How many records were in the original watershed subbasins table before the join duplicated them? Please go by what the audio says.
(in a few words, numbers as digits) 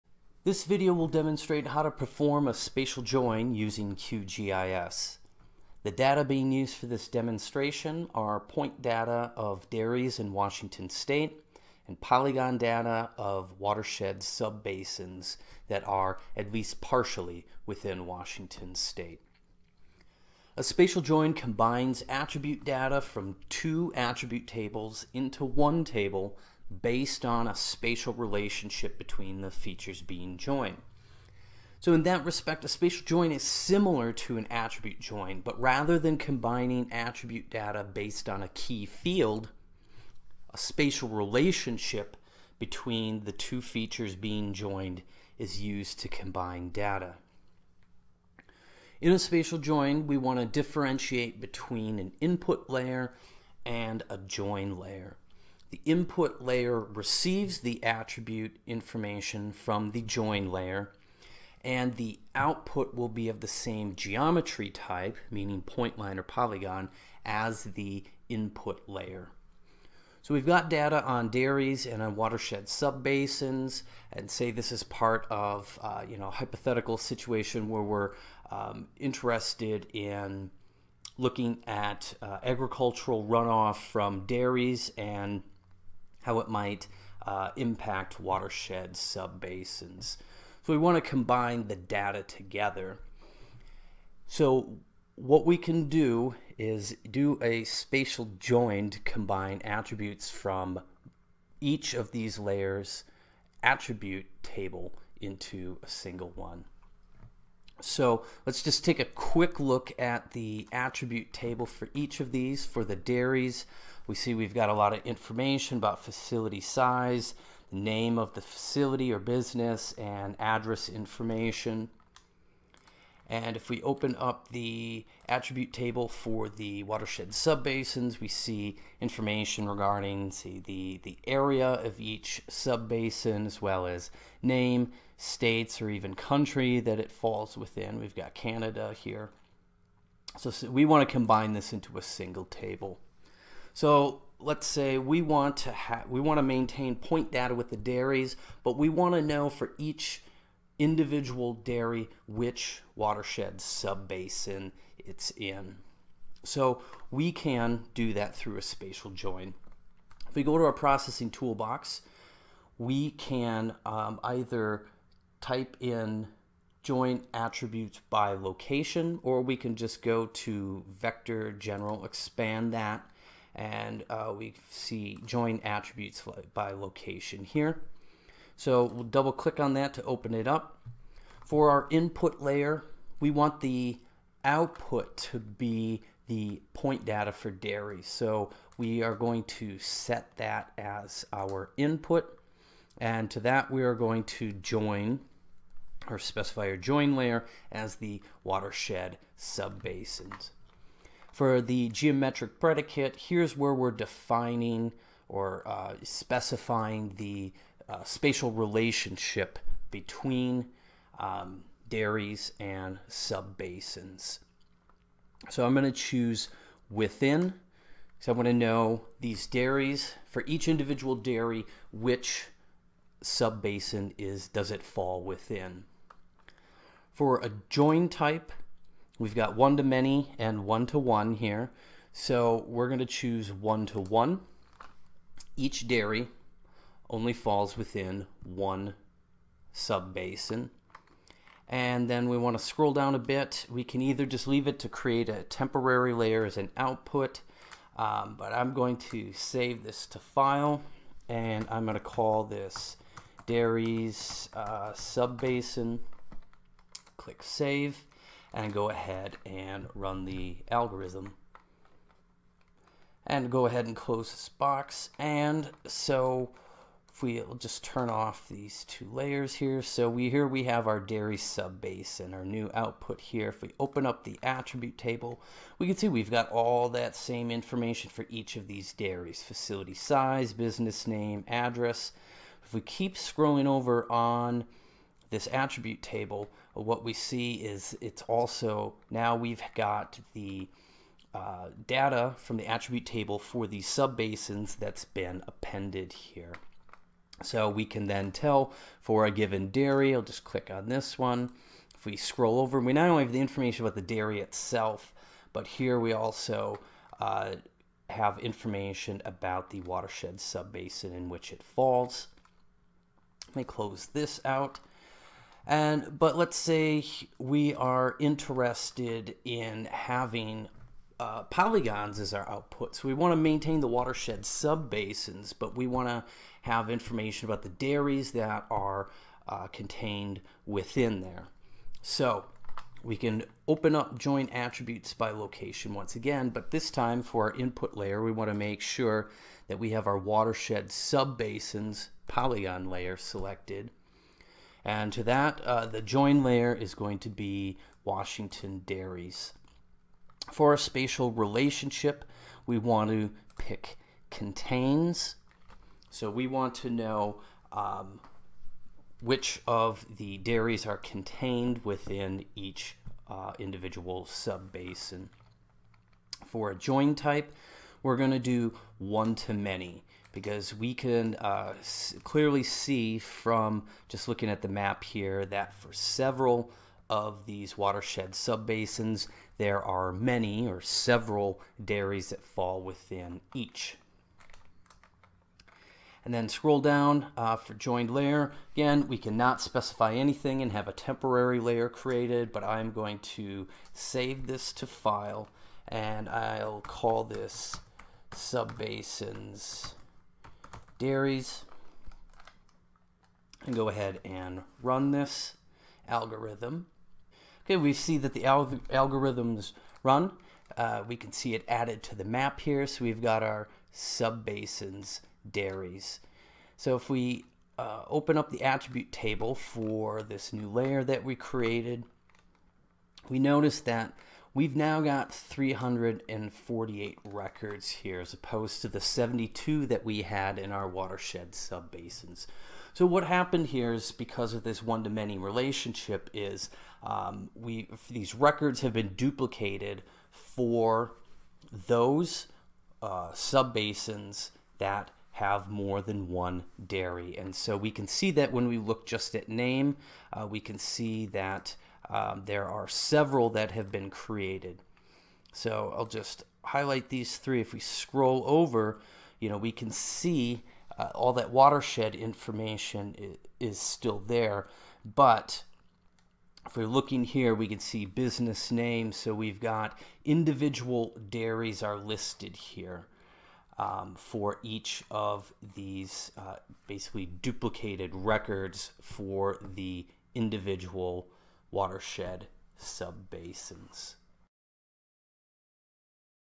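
72.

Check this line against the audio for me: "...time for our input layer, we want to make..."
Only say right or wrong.
right.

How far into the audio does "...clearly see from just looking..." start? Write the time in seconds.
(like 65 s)
372 s.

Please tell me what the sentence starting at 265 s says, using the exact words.
And so if we will just turn off these two layers here.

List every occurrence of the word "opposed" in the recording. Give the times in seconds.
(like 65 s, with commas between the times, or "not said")
428 s.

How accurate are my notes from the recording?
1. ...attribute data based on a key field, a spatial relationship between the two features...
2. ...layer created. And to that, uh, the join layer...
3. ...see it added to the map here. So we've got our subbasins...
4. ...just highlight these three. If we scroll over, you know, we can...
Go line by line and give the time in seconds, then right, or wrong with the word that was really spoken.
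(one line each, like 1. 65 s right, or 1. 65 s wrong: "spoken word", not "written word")
1. 36 s right
2. 342 s wrong: "selected", not "created"
3. 411 s right
4. 456 s right.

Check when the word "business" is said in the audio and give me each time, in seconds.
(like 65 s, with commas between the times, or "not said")
119 s, 280 s, 468 s.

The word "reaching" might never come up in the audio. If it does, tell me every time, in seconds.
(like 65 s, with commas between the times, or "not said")
not said.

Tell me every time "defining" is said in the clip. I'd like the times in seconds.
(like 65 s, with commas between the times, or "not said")
203 s.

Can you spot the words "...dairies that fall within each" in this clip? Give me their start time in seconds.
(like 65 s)
381 s.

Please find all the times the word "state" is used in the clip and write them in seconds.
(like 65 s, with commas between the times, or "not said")
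10 s, 18 s, 135 s.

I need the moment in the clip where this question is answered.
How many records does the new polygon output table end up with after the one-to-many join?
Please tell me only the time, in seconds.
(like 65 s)
425 s.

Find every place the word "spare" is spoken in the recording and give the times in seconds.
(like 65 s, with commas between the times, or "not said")
not said.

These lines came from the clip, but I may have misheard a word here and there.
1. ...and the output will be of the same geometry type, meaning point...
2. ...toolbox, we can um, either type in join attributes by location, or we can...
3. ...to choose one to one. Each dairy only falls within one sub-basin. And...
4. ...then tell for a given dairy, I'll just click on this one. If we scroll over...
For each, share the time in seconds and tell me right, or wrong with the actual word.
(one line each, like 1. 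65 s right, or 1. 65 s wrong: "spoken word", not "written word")
1. 61 s right
2. 161 s right
3. 232 s right
4. 298 s right.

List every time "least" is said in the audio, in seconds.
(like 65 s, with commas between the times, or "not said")
16 s.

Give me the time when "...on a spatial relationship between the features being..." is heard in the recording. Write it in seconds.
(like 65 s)
27 s.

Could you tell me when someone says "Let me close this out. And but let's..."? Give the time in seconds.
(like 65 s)
313 s.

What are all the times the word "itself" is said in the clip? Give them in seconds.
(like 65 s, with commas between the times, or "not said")
304 s.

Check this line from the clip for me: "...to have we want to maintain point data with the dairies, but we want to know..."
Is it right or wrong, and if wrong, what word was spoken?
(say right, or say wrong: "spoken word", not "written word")
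right.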